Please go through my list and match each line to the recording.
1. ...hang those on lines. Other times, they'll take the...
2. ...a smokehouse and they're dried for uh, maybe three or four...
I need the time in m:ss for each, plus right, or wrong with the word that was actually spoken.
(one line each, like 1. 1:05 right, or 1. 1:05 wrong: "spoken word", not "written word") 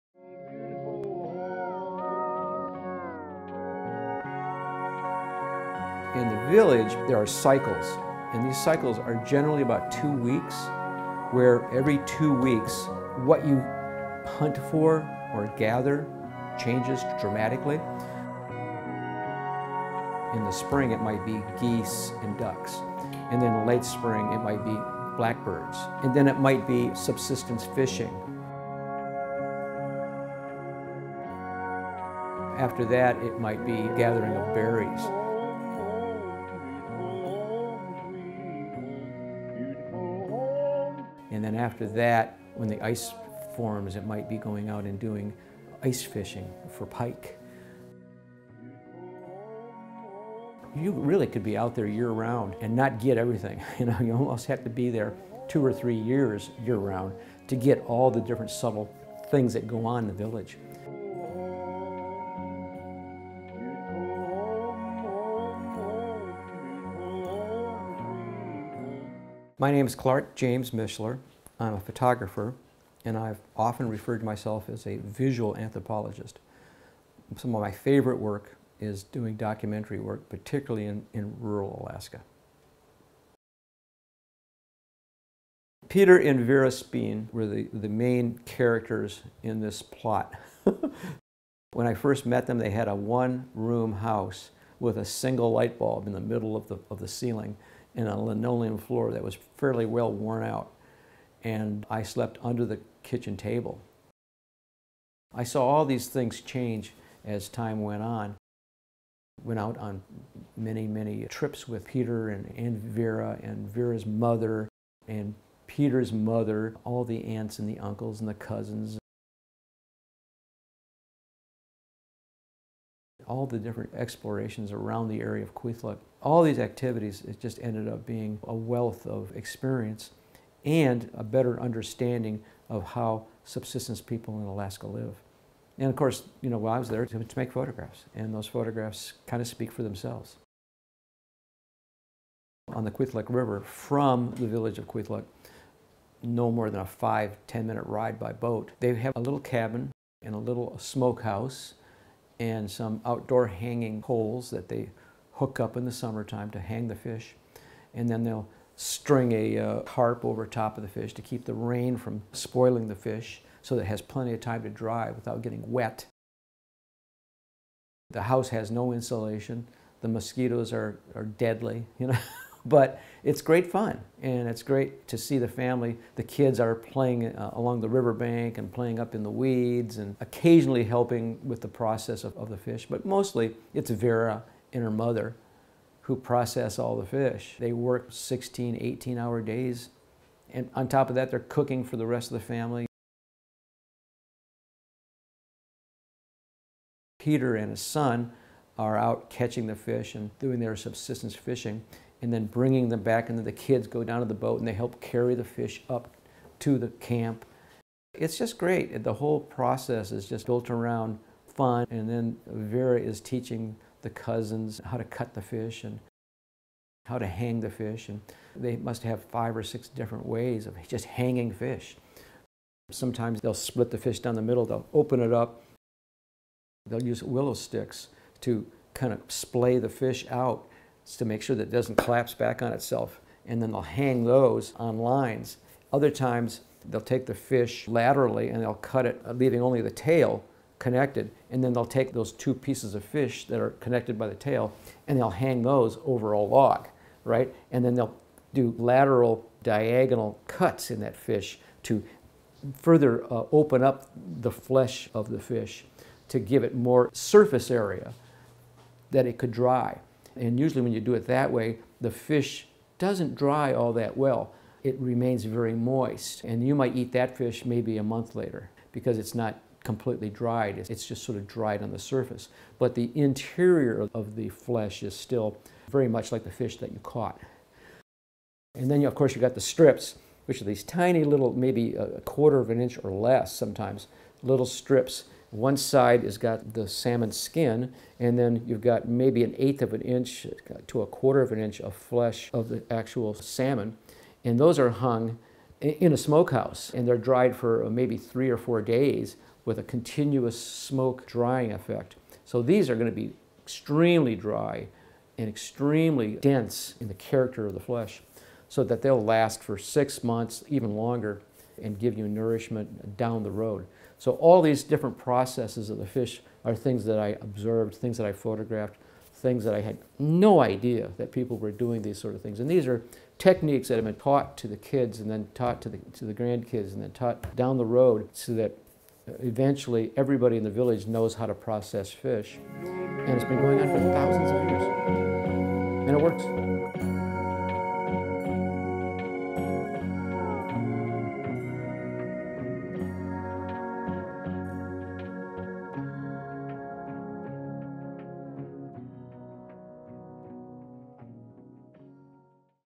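1. 3:53 right
2. 4:56 right.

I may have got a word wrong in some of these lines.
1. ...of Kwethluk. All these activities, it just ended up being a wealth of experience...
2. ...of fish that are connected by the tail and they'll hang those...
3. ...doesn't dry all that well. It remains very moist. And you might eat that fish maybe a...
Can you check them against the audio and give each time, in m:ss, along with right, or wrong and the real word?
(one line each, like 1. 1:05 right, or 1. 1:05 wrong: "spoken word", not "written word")
1. 2:05 right
2. 4:02 right
3. 4:22 right.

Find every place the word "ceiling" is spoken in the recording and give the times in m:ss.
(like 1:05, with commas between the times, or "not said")
1:37.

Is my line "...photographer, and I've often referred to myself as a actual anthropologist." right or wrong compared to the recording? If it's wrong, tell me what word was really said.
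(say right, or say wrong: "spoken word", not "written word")
wrong: "visual", not "actual".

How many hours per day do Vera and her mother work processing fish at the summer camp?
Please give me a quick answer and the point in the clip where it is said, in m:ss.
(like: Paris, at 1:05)
16 to 18 hours, at 3:08.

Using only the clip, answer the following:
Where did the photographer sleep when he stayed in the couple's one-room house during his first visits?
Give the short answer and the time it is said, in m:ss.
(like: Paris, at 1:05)
under the kitchen table, at 1:42.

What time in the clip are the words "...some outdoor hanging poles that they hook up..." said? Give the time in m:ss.
2:32.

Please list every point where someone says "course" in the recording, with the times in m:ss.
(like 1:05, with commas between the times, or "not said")
2:15, 4:39.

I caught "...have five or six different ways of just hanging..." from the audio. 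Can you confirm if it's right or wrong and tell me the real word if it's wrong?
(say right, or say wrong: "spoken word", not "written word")
right.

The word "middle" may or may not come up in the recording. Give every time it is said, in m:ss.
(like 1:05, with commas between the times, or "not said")
1:36, 3:44.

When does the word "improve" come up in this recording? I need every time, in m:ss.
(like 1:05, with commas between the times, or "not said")
not said.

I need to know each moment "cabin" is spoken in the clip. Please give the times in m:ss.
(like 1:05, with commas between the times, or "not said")
2:29.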